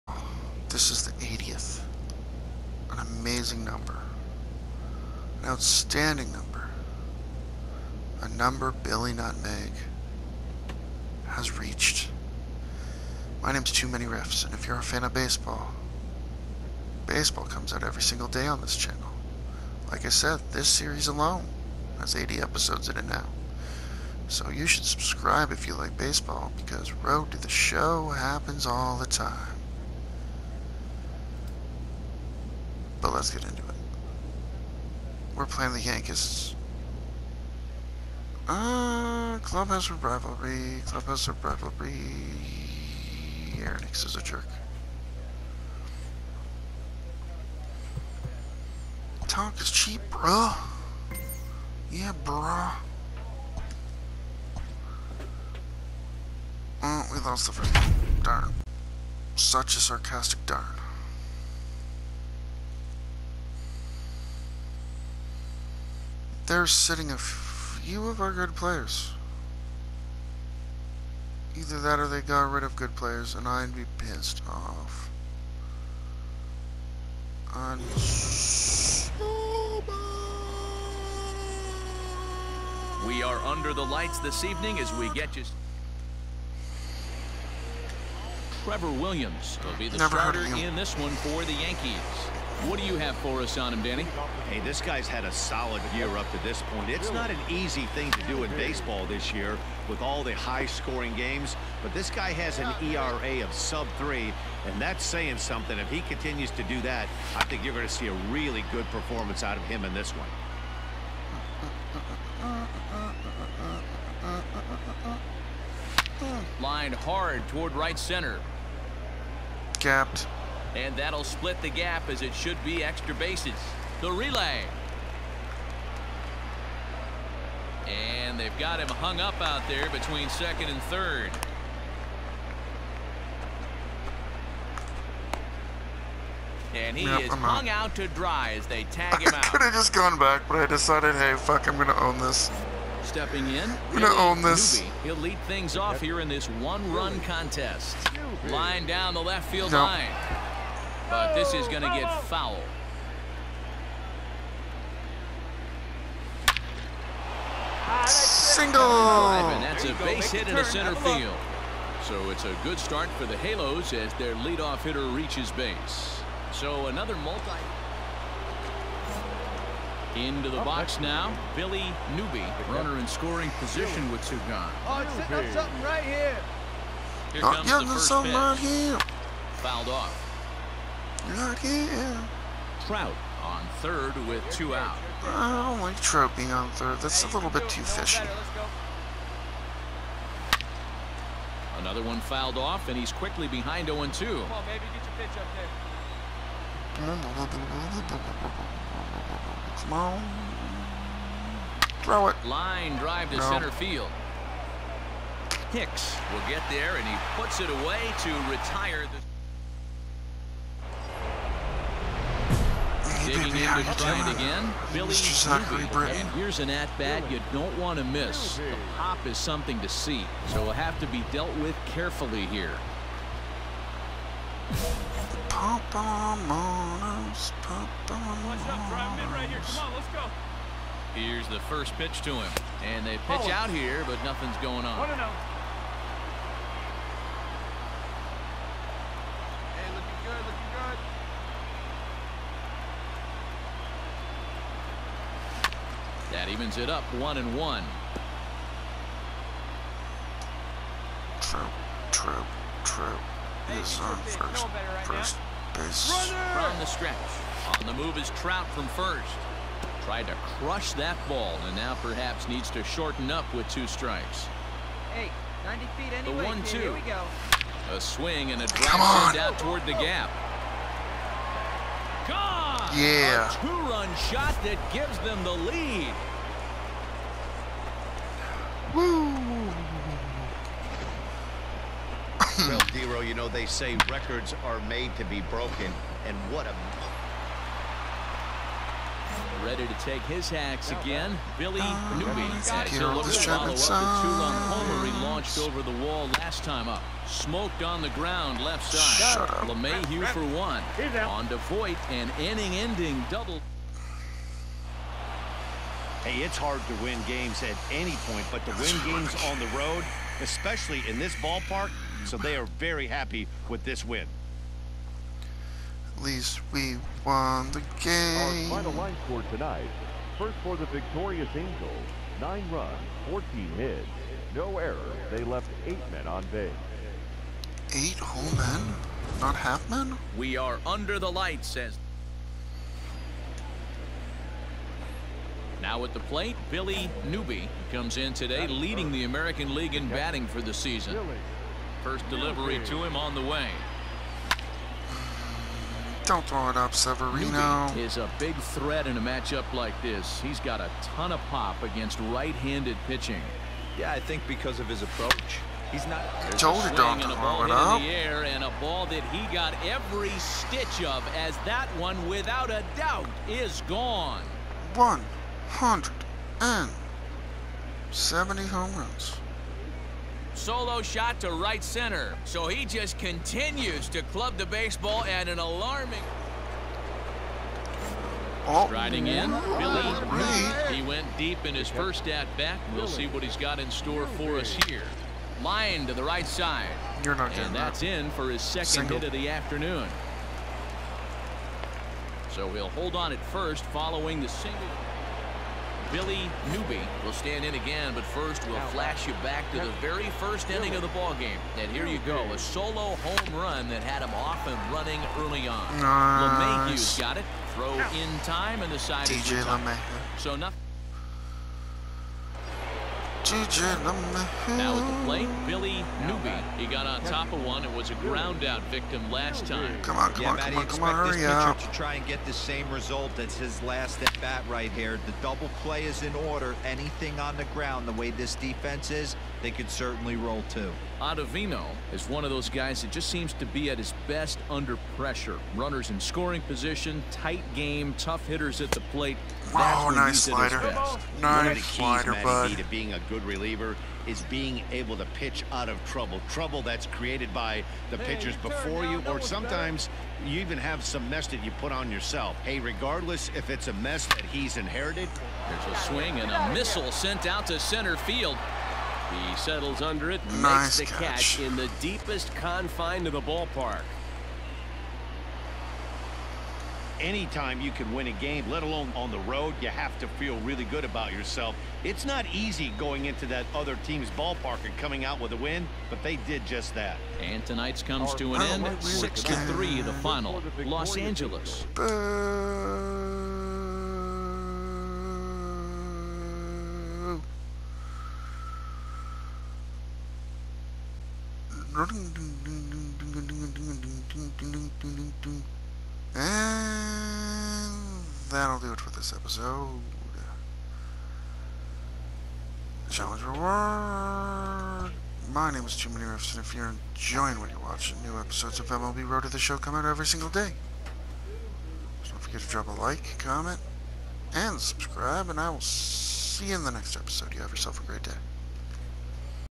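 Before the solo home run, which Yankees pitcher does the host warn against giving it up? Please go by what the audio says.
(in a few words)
Severino.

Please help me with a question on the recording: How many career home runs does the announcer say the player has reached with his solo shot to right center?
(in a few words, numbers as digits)
170.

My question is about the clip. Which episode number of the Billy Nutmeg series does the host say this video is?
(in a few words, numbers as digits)
80th.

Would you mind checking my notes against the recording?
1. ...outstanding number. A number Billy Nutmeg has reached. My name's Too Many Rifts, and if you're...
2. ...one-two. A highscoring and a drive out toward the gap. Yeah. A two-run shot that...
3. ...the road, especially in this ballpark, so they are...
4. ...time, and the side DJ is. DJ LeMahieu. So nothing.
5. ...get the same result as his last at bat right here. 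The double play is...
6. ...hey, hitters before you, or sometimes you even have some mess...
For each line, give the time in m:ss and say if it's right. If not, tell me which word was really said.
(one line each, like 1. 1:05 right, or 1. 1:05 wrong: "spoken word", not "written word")
1. 0:05 right
2. 4:26 wrong: "swing", not "highscoring"
3. 5:09 right
4. 6:48 right
5. 7:02 right
6. 7:28 wrong: "pitchers", not "hitters".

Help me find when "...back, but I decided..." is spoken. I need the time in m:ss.
2:20.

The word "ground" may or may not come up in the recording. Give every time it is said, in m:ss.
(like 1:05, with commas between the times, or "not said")
4:58, 6:58, 7:07.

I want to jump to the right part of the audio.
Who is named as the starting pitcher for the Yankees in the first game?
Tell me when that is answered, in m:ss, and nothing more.
1:28.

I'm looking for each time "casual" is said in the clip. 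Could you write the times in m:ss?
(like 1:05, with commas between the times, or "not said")
not said.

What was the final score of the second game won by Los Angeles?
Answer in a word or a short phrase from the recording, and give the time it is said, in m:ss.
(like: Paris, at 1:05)
6-3, at 7:58.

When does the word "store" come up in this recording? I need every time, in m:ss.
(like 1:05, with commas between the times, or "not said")
6:23.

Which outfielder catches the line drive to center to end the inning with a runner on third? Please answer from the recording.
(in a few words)
Hicks.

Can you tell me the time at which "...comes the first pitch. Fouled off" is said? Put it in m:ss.
2:57.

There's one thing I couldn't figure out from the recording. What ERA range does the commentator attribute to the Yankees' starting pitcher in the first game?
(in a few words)
sub-3.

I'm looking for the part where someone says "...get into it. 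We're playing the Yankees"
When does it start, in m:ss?
0:33.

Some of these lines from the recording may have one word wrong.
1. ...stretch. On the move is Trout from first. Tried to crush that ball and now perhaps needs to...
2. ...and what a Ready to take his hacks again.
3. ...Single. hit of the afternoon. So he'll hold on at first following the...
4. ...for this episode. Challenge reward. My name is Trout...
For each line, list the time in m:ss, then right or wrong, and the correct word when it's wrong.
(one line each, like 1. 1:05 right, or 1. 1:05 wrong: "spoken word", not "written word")
1. 4:16 right
2. 4:46 right
3. 6:28 right
4. 8:19 wrong: "Jimmy", not "Trout".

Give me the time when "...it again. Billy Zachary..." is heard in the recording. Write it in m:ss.
3:34.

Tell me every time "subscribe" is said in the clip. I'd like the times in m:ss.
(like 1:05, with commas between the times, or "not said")
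0:24, 8:34.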